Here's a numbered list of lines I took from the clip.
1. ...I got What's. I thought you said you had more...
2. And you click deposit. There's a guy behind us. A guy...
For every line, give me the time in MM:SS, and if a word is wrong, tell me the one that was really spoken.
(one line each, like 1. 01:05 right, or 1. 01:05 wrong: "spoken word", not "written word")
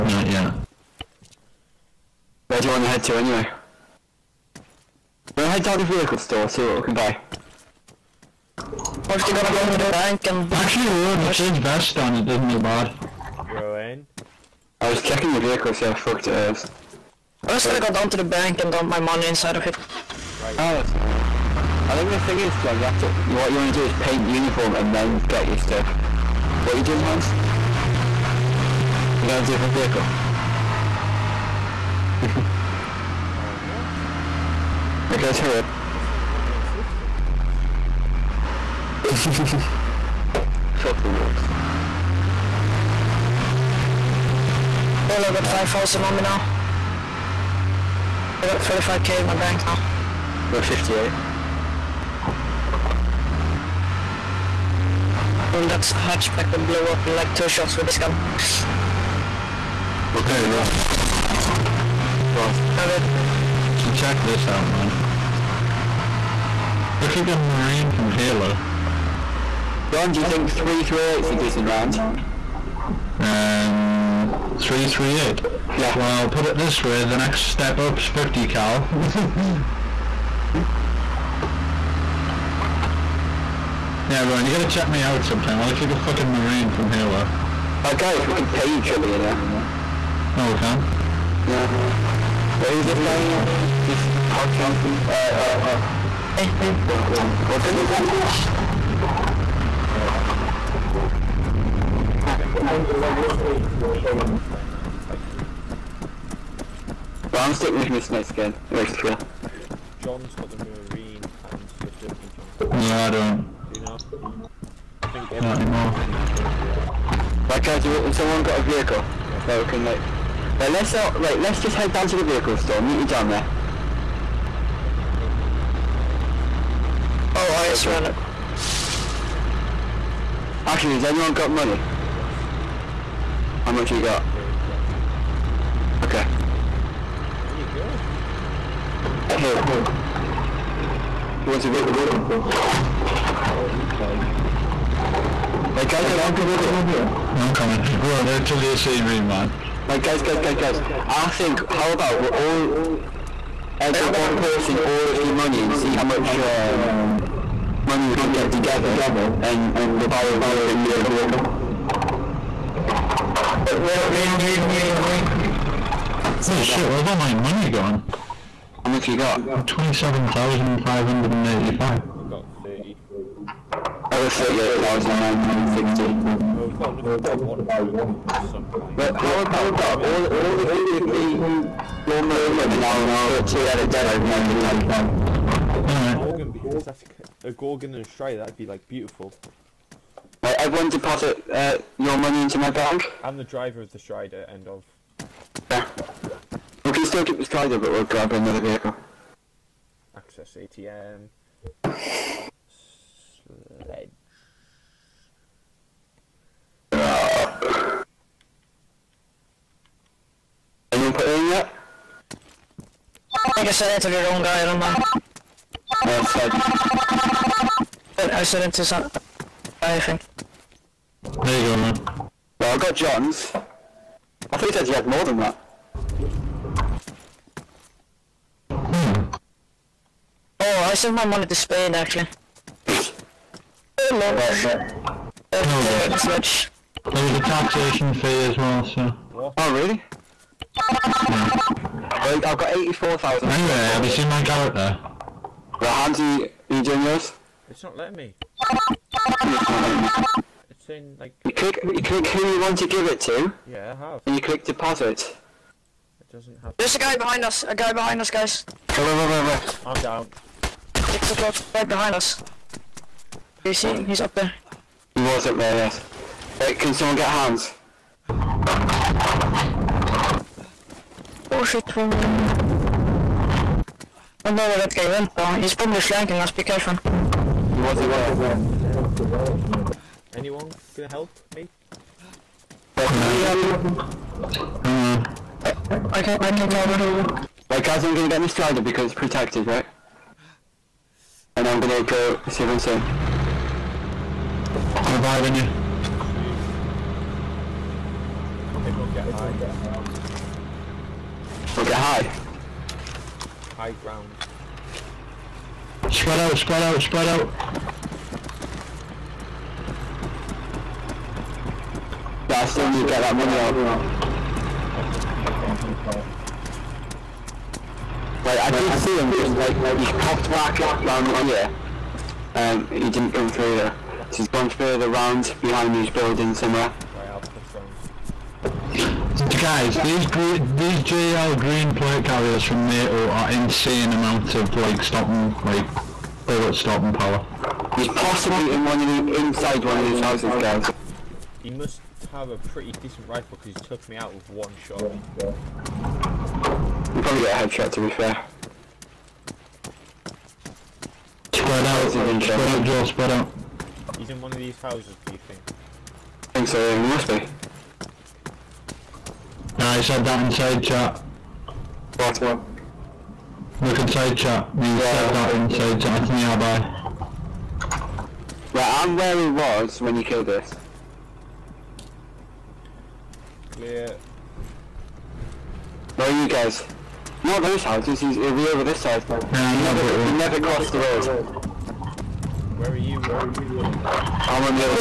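1. 03:42 wrong: "John", not "What"
2. 04:14 right.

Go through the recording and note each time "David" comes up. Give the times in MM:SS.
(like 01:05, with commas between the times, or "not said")
01:02.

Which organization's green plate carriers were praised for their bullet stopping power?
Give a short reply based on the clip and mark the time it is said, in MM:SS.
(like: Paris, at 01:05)
NATO, at 05:32.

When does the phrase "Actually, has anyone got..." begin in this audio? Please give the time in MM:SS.
02:10.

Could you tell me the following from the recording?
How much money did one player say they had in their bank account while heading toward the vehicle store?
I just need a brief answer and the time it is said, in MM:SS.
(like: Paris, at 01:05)
35k, at 00:48.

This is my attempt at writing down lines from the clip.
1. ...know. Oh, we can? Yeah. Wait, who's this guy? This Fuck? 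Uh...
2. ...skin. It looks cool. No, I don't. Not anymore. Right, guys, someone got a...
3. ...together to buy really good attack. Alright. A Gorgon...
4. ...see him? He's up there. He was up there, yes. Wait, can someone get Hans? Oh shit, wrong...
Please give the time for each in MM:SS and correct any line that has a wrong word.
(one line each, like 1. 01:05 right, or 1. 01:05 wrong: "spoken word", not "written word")
1. 01:29 wrong: "Pouching", not "Fuck"
2. 01:48 right
3. 03:03 right
4. 04:23 right.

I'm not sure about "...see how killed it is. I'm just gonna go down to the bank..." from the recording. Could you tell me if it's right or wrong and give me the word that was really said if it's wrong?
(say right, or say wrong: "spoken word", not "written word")
wrong: "fucked", not "killed".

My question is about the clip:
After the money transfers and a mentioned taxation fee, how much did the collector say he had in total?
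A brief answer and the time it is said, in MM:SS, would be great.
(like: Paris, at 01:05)
84,000, at 04:02.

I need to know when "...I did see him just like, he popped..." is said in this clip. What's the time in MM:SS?
05:18.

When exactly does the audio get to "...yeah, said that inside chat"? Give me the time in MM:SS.
06:04.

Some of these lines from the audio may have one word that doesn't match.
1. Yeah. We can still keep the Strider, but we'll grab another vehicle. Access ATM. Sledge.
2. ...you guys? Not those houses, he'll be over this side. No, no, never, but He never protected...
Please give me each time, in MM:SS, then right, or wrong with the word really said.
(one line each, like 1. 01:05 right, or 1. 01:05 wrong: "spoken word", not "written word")
1. 03:15 right
2. 06:16 wrong: "crossed", not "protected".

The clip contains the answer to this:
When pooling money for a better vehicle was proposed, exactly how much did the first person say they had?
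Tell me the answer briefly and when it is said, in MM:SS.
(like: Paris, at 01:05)
27,585, at 02:49.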